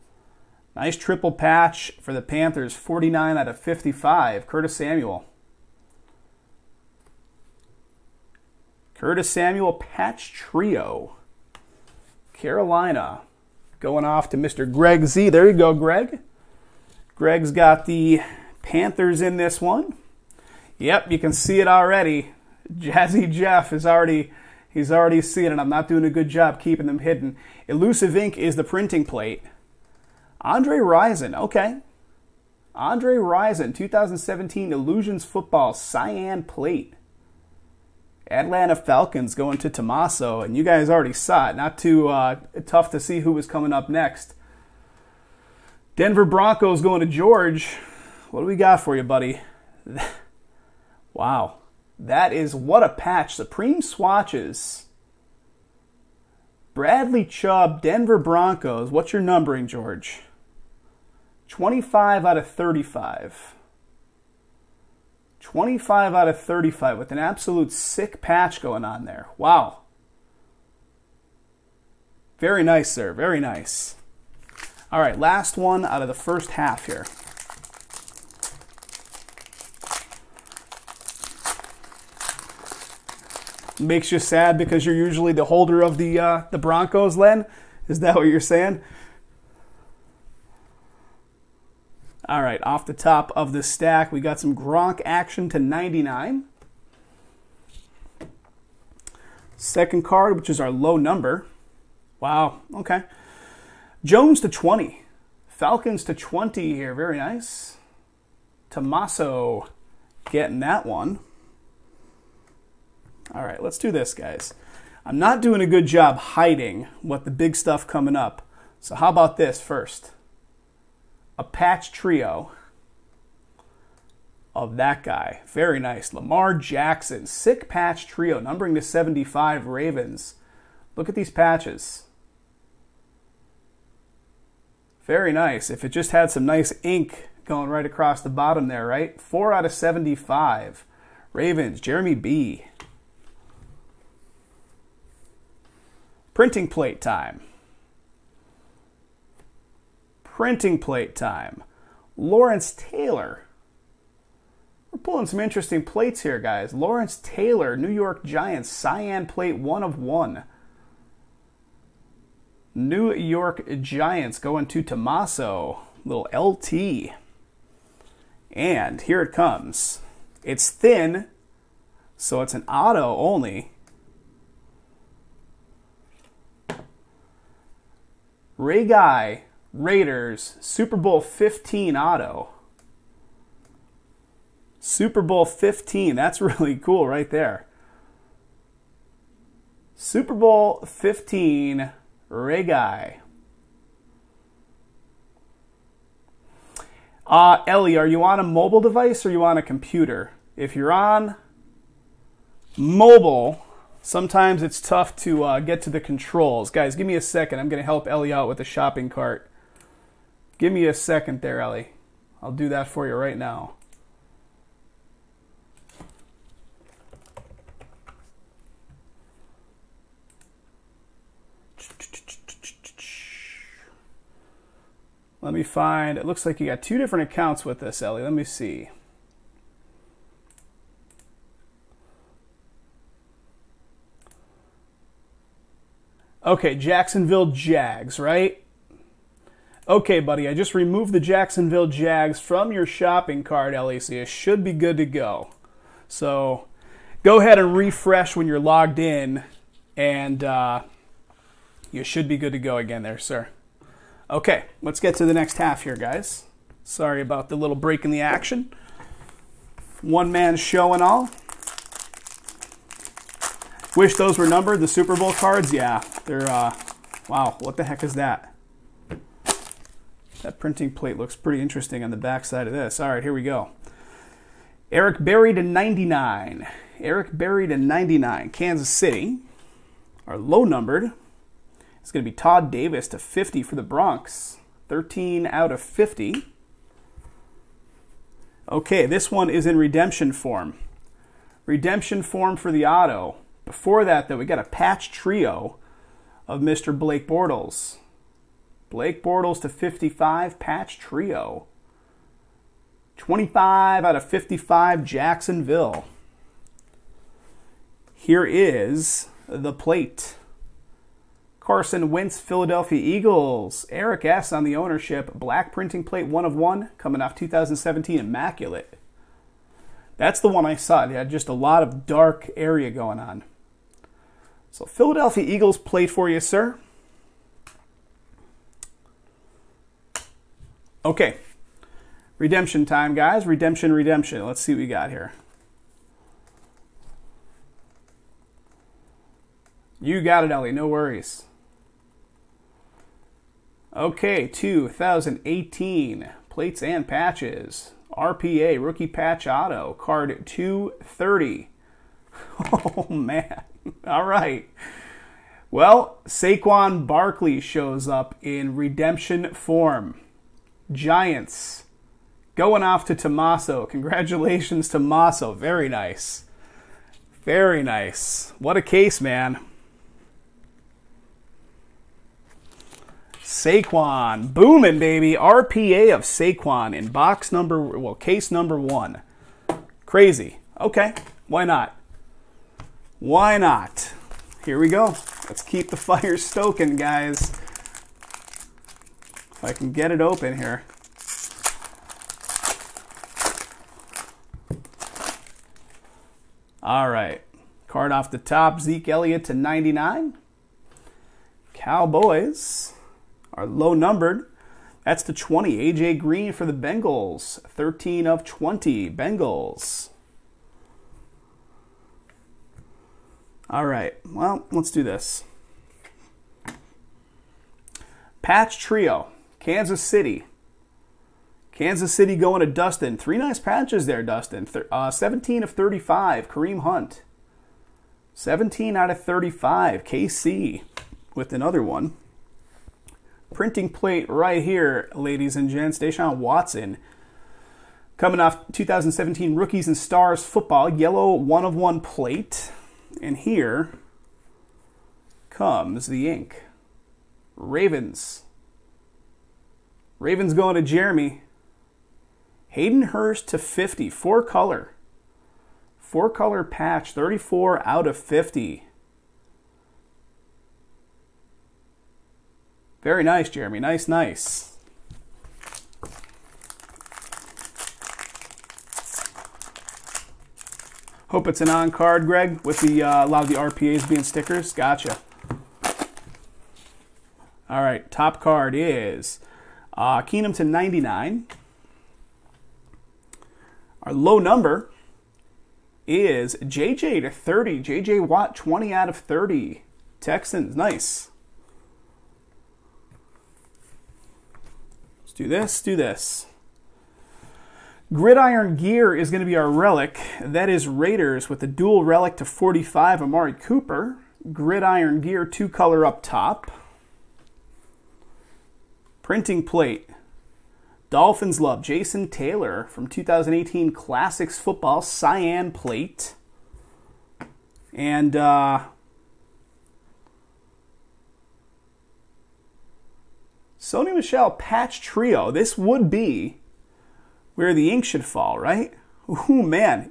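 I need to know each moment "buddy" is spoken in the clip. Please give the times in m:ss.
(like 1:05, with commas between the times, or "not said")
0:49, 4:00.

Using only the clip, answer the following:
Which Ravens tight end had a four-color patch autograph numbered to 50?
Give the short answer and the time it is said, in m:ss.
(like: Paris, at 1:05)
Hayden Hurst, at 7:32.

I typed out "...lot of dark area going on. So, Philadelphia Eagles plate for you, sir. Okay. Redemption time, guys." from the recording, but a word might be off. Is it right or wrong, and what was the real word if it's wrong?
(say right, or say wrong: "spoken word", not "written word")
right.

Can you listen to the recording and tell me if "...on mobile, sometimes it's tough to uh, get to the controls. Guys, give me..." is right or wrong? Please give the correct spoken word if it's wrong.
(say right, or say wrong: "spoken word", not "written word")
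right.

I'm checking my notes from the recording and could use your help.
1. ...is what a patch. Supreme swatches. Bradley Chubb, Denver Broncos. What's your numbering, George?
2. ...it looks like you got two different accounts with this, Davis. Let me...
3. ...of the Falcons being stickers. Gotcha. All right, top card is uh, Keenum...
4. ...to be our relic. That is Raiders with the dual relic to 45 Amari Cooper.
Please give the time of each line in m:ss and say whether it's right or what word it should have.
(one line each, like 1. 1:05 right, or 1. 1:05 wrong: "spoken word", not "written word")
1. 0:52 right
2. 3:46 wrong: "Ellie", not "Davis"
3. 7:53 wrong: "RPAs", not "Falcons"
4. 8:19 right.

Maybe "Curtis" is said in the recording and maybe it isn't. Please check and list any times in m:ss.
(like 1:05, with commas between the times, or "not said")
0:04, 0:08.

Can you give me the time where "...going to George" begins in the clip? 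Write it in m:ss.
0:46.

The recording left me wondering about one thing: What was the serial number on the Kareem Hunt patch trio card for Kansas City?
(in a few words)
17 of 35.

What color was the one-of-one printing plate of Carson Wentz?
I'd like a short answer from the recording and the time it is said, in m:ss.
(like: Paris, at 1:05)
Black, at 5:15.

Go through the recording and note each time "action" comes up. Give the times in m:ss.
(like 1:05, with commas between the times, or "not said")
1:35, 4:18.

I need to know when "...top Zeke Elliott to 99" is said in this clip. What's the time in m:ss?
6:38.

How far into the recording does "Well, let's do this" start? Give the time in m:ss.
6:54.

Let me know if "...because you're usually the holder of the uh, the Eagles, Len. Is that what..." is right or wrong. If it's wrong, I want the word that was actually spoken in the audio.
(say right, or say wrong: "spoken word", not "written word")
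wrong: "Broncos", not "Eagles".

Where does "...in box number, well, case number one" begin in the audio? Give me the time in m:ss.
6:16.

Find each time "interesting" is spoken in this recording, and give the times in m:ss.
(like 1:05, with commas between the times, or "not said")
2:35, 4:31.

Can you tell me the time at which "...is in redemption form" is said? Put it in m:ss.
4:49.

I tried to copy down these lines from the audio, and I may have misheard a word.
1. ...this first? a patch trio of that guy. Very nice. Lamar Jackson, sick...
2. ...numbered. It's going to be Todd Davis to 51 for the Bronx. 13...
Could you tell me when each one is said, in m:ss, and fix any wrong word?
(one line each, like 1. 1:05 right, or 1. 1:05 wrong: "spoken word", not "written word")
1. 1:59 right
2. 4:40 wrong: "50", not "51".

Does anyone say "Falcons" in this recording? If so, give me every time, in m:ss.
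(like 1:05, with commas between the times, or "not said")
0:38, 1:45.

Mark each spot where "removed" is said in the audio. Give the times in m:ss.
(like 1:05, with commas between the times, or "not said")
4:00.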